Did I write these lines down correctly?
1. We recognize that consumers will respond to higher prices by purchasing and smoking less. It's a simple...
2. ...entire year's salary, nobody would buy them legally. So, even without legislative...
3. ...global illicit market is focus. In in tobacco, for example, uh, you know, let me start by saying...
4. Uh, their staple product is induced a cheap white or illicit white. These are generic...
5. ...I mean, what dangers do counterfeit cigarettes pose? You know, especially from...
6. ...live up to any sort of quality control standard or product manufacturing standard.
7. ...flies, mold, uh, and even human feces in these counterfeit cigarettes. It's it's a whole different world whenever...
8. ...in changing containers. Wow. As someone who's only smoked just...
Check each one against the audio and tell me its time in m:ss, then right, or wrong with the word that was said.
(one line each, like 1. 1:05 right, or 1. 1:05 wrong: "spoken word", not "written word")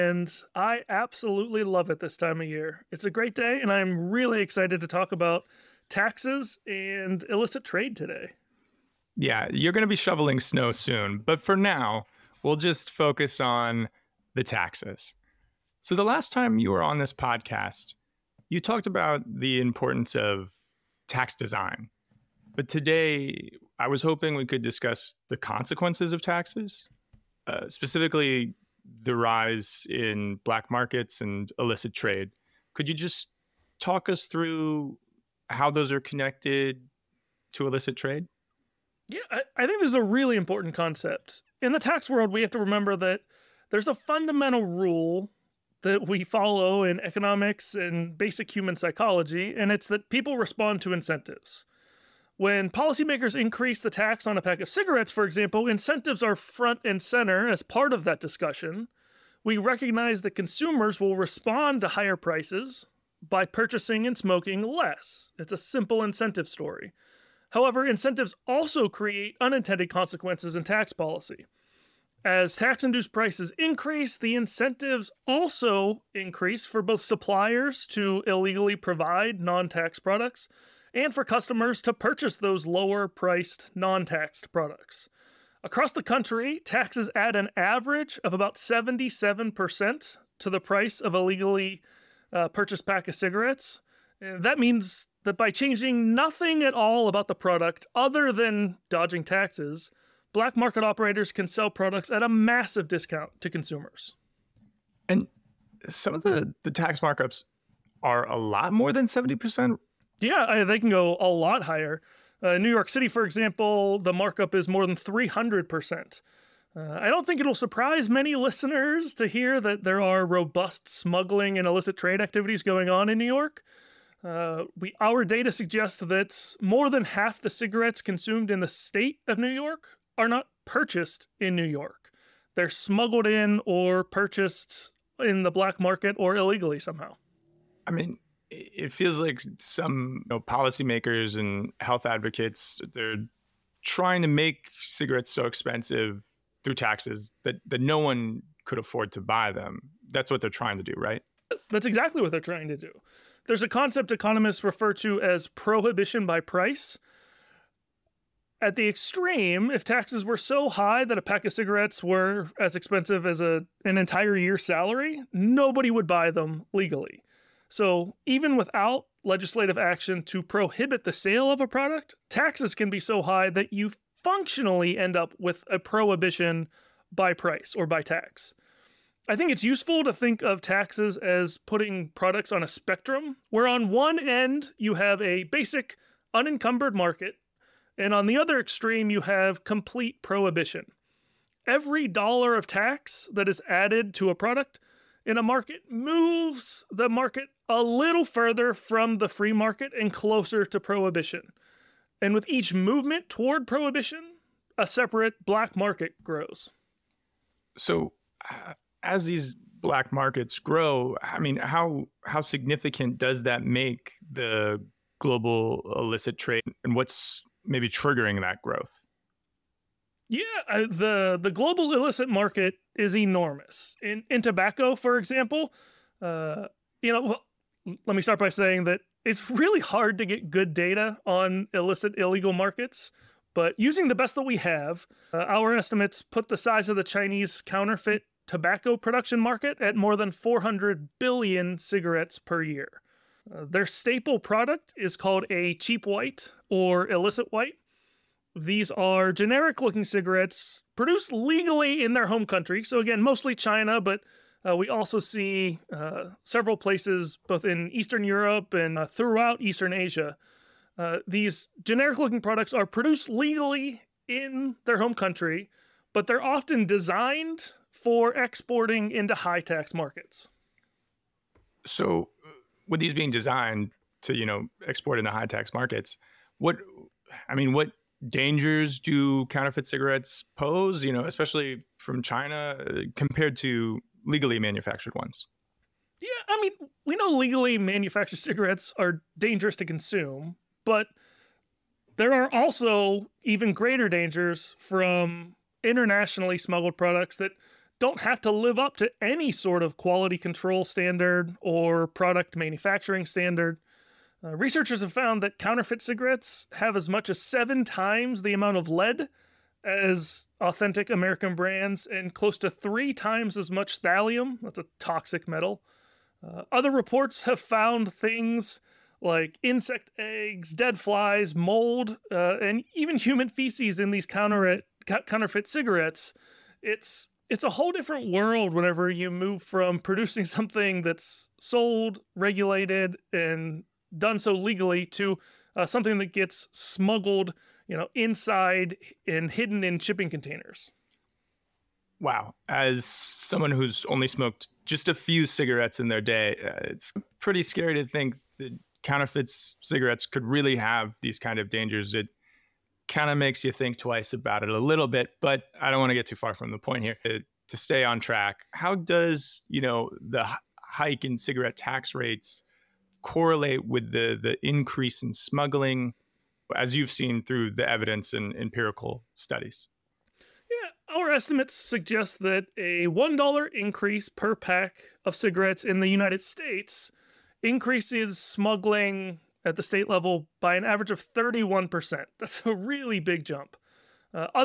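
1. 0:59 right
2. 2:43 right
3. 3:41 wrong: "enormous", not "focus"
4. 4:03 wrong: "called", not "induced"
5. 4:37 right
6. 4:58 right
7. 5:20 right
8. 5:39 wrong: "shipping", not "changing".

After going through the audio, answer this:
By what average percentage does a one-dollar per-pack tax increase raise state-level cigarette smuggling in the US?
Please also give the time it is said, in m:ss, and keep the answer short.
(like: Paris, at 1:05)
31%, at 6:21.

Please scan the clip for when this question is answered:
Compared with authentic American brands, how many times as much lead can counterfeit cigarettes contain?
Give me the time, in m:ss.
5:07.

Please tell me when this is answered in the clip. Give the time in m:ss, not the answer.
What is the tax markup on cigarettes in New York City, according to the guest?
1:54.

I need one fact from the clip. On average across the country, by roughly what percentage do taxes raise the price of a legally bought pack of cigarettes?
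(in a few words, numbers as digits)
77%.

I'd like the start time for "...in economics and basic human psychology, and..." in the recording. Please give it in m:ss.
0:46.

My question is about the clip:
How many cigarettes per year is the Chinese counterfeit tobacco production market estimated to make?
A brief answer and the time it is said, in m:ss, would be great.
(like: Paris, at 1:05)
more than 400 billion, at 3:59.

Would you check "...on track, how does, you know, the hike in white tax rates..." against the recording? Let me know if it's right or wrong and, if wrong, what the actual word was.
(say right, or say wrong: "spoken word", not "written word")
wrong: "cigarette", not "white".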